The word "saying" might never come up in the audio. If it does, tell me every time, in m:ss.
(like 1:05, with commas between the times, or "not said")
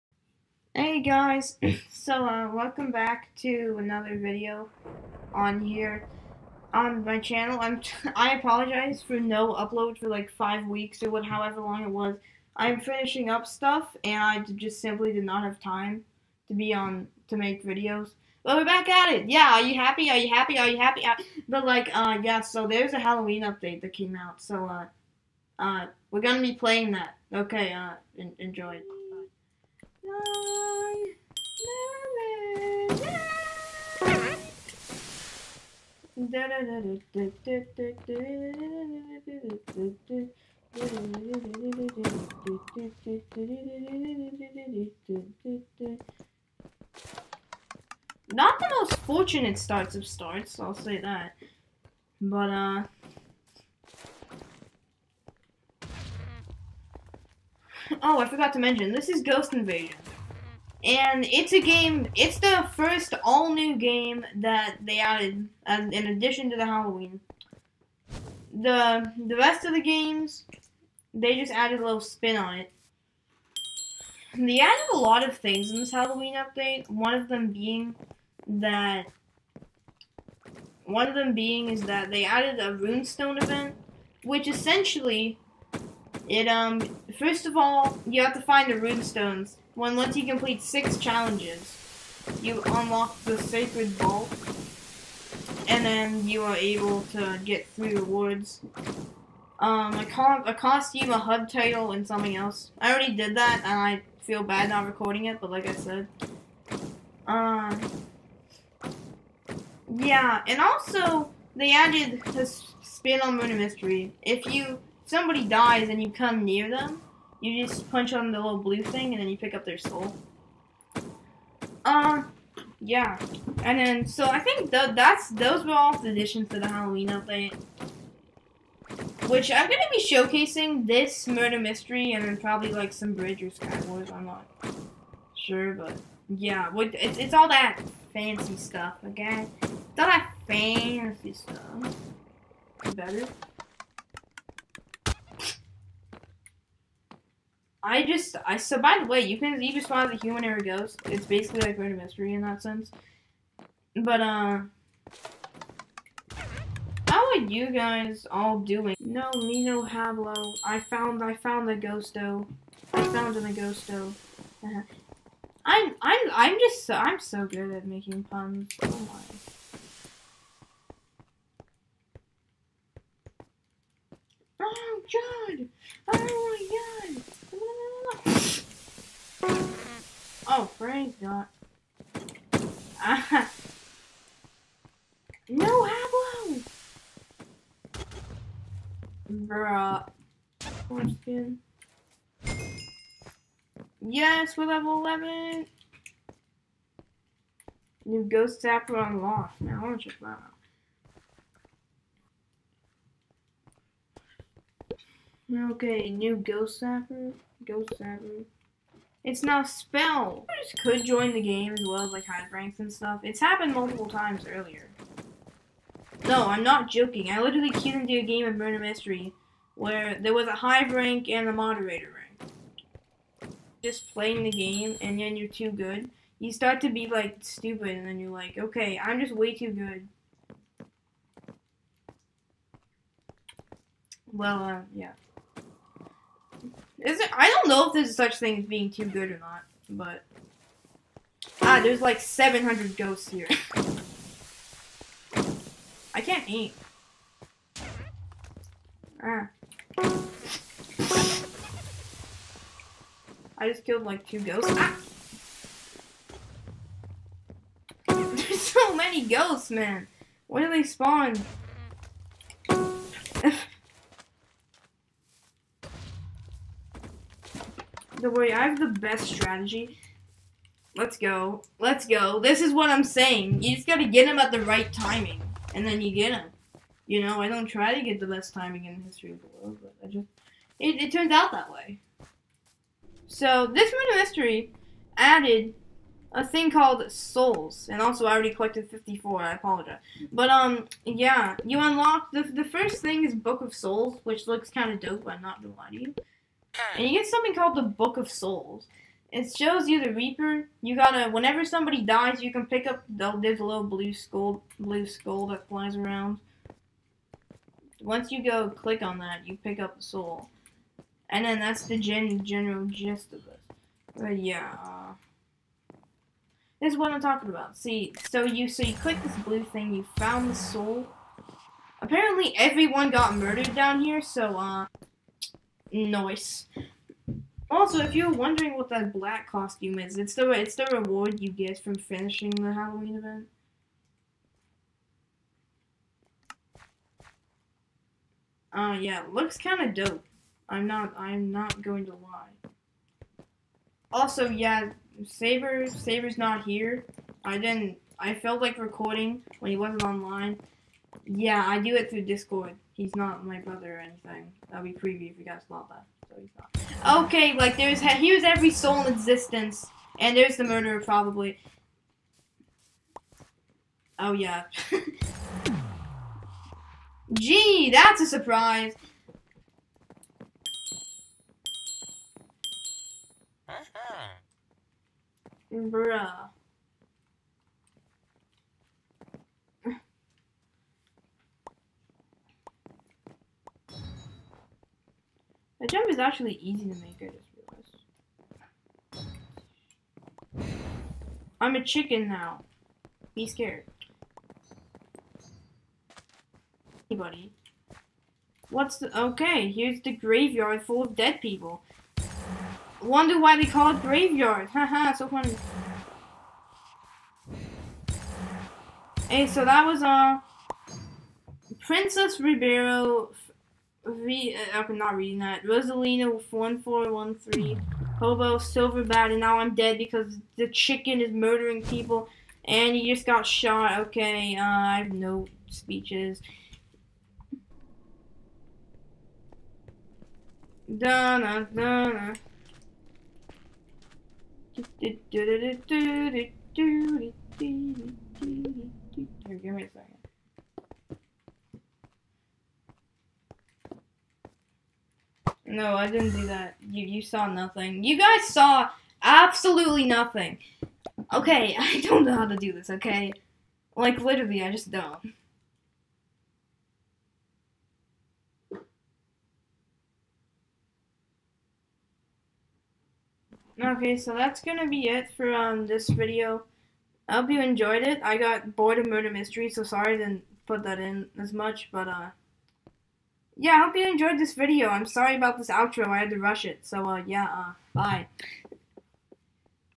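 4:33.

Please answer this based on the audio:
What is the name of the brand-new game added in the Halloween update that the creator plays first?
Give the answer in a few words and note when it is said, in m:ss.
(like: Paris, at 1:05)
Ghost Invasion, at 0:59.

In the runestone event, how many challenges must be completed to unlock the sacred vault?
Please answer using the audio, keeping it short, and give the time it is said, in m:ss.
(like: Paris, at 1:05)
6, at 1:30.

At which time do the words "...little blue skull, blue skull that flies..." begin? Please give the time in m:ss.
5:03.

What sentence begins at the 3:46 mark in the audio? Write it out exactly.
You start to be like stupid and then you're like, okay, I'm just way too good.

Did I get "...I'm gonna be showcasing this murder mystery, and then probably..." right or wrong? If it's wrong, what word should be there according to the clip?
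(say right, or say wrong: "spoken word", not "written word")
right.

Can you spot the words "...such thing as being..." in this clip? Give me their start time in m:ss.
3:58.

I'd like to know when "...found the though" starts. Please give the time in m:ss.
2:41.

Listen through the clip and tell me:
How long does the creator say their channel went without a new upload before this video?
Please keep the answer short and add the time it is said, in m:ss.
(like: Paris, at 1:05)
5 weeks, at 0:10.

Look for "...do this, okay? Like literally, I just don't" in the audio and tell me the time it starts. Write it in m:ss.
7:32.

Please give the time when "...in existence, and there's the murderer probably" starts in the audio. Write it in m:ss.
5:59.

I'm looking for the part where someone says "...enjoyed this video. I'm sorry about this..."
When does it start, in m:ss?
7:54.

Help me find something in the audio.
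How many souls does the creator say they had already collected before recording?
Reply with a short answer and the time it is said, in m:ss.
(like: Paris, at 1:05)
54, at 4:48.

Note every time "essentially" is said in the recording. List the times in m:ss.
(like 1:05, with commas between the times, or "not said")
1:24.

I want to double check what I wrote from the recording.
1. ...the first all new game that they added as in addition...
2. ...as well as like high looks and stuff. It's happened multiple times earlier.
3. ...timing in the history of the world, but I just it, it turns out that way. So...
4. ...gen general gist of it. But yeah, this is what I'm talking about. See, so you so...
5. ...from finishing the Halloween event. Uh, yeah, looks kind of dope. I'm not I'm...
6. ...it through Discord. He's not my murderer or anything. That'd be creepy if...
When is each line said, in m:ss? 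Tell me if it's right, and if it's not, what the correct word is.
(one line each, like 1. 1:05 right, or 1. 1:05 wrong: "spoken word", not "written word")
1. 1:02 right
2. 3:31 wrong: "ranks", not "looks"
3. 4:38 right
4. 5:11 right
5. 5:31 right
6. 5:51 wrong: "brother", not "murderer".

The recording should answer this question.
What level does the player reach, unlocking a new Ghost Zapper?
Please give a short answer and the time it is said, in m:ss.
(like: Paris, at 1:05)
11, at 3:14.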